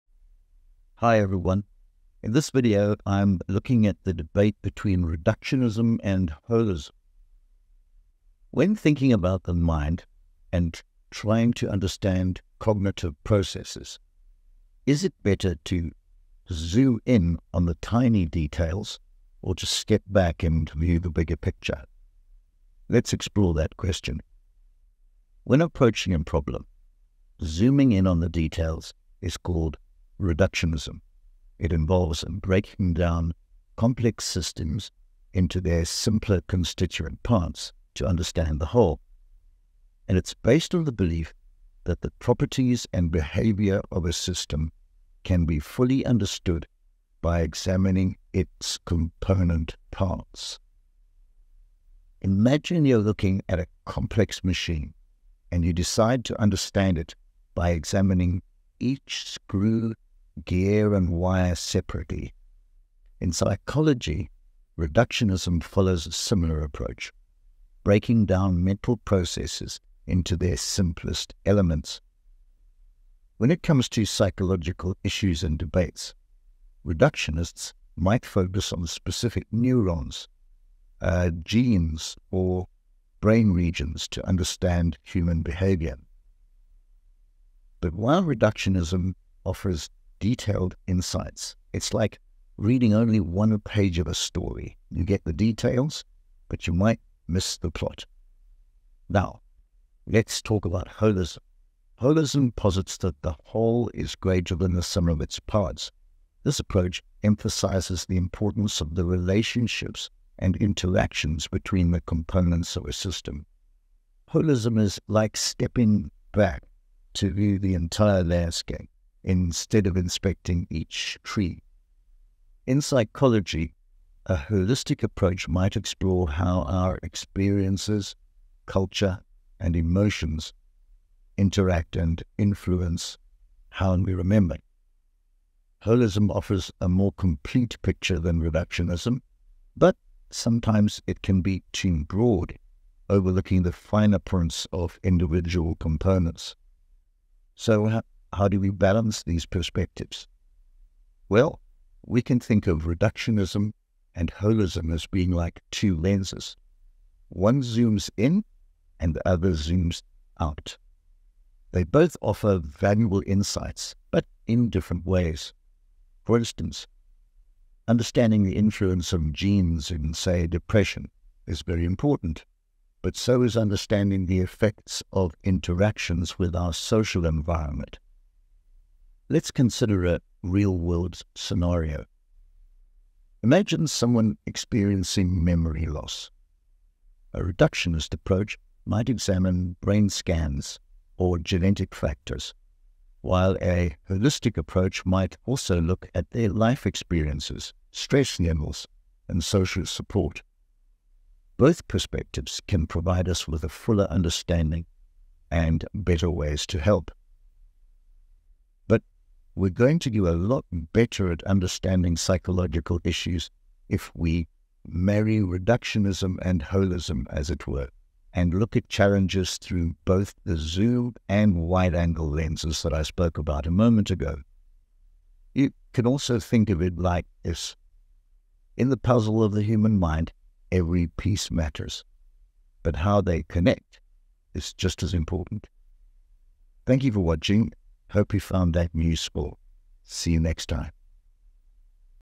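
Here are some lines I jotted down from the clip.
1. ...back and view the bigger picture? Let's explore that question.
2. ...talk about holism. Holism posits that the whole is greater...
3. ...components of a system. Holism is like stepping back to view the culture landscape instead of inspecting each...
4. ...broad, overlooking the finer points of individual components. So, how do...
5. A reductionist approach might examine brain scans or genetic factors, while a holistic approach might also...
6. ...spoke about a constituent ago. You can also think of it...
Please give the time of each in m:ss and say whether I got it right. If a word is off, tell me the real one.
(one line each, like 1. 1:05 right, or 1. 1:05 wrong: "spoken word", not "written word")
1. 0:20 right
2. 1:40 right
3. 1:52 wrong: "entire", not "culture"
4. 2:22 right
5. 3:07 right
6. 3:43 wrong: "moment", not "constituent".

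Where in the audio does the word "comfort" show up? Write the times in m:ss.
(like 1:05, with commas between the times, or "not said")
not said.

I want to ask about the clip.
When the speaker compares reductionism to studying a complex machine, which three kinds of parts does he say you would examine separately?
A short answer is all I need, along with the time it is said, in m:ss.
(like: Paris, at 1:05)
screw, gear and wire, at 0:59.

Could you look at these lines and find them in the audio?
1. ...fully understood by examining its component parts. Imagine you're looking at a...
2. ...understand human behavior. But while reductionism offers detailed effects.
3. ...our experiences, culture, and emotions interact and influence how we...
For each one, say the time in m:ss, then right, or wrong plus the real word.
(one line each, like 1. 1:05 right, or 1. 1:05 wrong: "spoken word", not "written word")
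1. 0:45 right
2. 1:24 wrong: "insights", not "effects"
3. 2:06 right.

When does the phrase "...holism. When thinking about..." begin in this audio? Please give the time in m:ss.
0:06.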